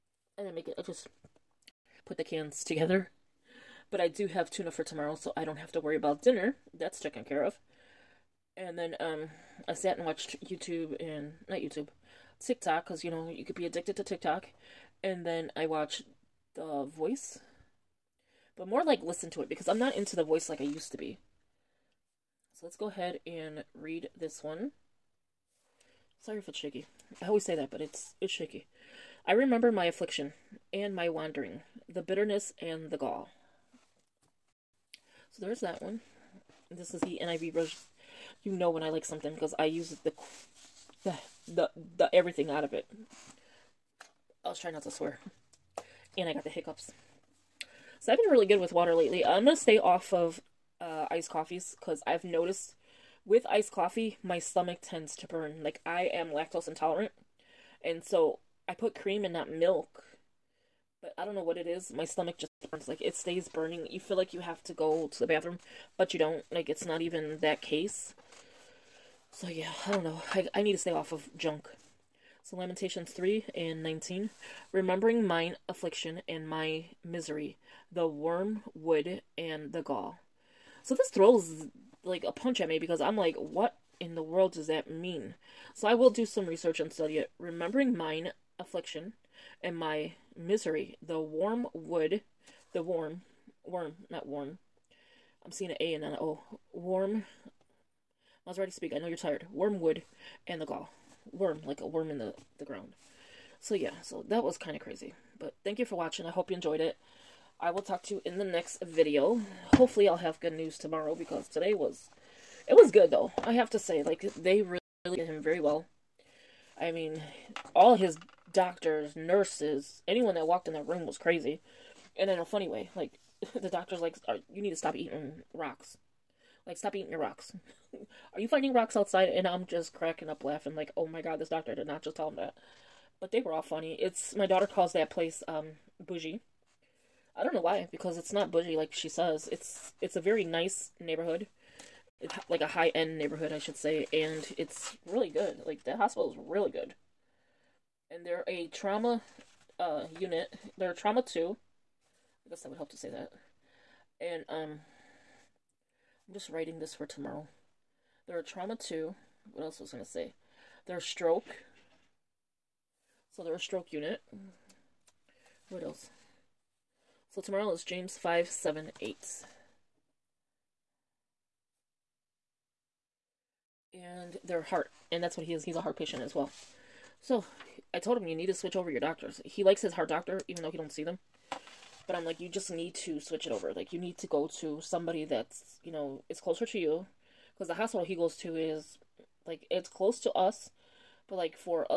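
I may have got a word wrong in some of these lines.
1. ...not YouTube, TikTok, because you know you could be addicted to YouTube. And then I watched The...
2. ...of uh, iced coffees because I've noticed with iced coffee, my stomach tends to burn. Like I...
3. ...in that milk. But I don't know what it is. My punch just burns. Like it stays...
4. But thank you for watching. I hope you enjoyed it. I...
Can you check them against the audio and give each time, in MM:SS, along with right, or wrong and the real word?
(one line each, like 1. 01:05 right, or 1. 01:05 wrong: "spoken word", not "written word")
1. 00:11 wrong: "TikTok", not "YouTube"
2. 00:50 right
3. 00:59 wrong: "stomach", not "punch"
4. 01:45 right.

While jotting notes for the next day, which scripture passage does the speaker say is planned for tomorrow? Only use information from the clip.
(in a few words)
James 5:7-8.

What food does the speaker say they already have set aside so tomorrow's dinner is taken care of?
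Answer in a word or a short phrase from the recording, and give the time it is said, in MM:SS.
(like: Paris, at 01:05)
tuna, at 00:04.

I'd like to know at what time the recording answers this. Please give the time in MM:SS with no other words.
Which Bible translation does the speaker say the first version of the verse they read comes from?
00:37.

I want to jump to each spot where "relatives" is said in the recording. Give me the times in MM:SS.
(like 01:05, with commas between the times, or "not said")
not said.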